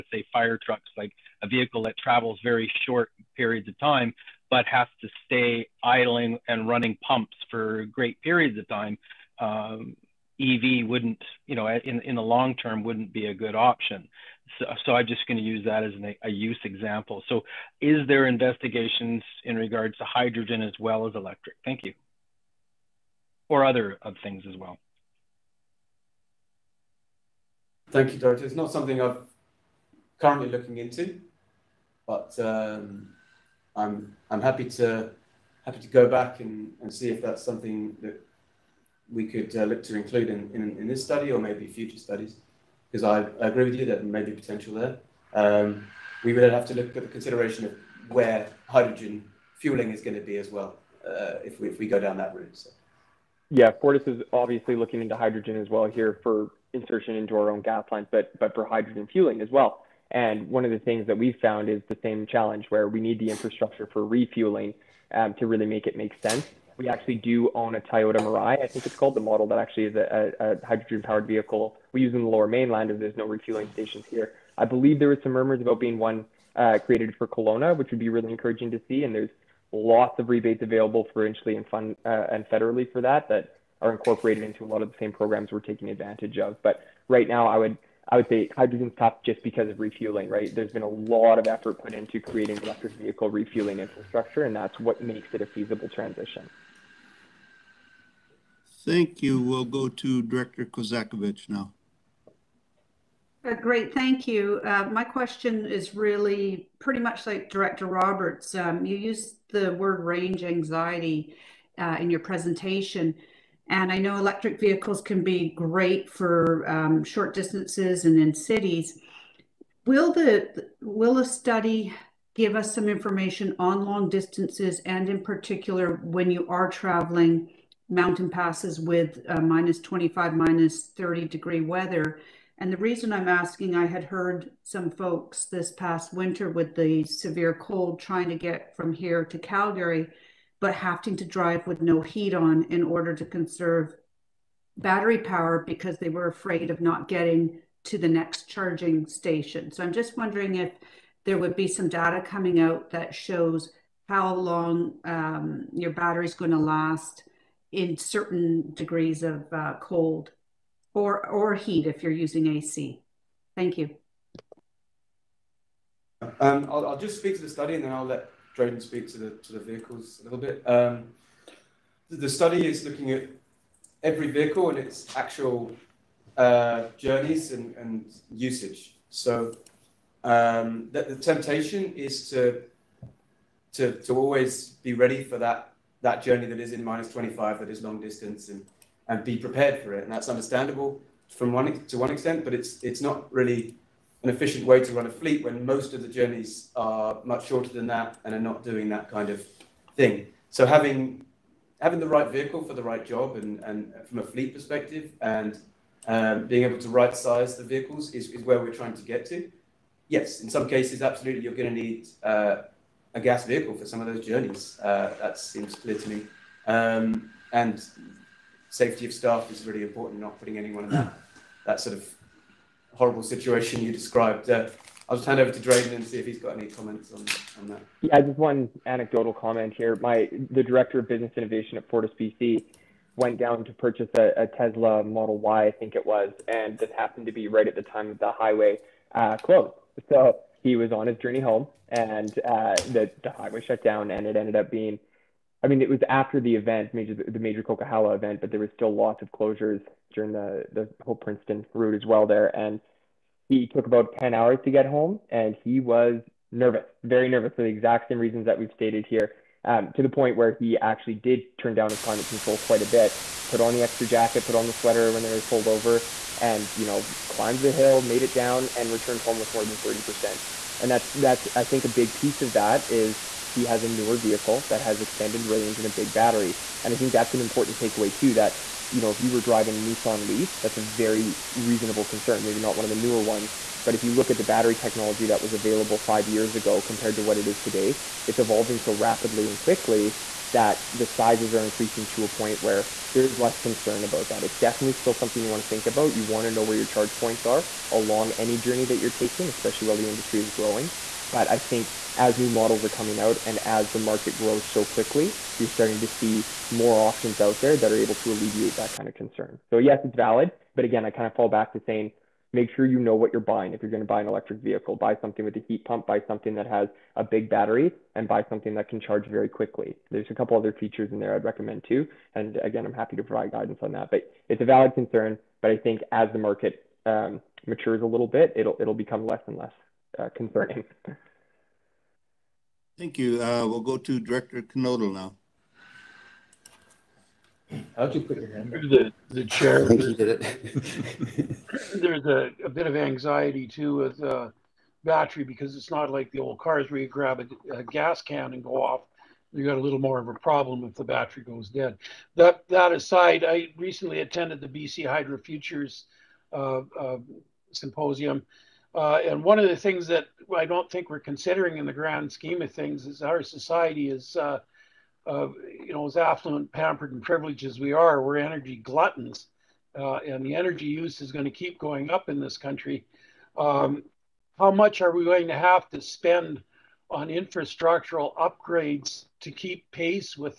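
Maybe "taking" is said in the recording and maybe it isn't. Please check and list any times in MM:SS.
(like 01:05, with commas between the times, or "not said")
01:25, 04:59.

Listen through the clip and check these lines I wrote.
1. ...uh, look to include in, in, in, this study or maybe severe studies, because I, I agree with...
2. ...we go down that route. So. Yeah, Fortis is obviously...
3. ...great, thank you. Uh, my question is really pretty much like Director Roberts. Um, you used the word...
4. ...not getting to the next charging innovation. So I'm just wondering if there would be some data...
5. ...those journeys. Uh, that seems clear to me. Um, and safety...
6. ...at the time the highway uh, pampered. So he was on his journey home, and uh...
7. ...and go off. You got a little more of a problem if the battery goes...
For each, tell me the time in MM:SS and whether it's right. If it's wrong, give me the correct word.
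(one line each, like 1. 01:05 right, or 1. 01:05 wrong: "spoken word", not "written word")
1. 00:39 wrong: "future", not "severe"
2. 00:51 right
3. 01:43 right
4. 02:26 wrong: "station", not "innovation"
5. 03:34 right
6. 03:57 wrong: "closed", not "pampered"
7. 05:48 right.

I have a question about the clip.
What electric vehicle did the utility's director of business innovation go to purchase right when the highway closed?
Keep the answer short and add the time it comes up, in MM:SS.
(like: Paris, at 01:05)
Tesla Model Y, at 03:54.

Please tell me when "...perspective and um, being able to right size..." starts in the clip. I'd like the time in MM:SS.
03:24.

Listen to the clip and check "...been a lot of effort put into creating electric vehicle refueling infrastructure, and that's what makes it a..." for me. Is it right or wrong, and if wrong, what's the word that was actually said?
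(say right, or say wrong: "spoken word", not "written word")
right.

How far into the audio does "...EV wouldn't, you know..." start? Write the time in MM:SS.
00:10.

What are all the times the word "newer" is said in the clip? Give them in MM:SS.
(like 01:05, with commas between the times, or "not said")
04:33, 04:42.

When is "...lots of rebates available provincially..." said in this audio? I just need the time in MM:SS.
01:19.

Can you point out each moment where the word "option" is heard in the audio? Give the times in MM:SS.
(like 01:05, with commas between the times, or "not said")
00:13, 05:07.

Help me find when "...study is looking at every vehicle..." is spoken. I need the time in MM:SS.
02:52.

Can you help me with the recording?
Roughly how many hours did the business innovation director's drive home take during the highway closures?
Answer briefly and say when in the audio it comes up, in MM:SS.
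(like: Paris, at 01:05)
10, at 04:14.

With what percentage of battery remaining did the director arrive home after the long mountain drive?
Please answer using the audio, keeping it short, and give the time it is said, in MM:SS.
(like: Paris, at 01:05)
30%, at 04:29.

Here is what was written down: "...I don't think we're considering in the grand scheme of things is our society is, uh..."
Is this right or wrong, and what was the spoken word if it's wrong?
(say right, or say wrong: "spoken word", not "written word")
right.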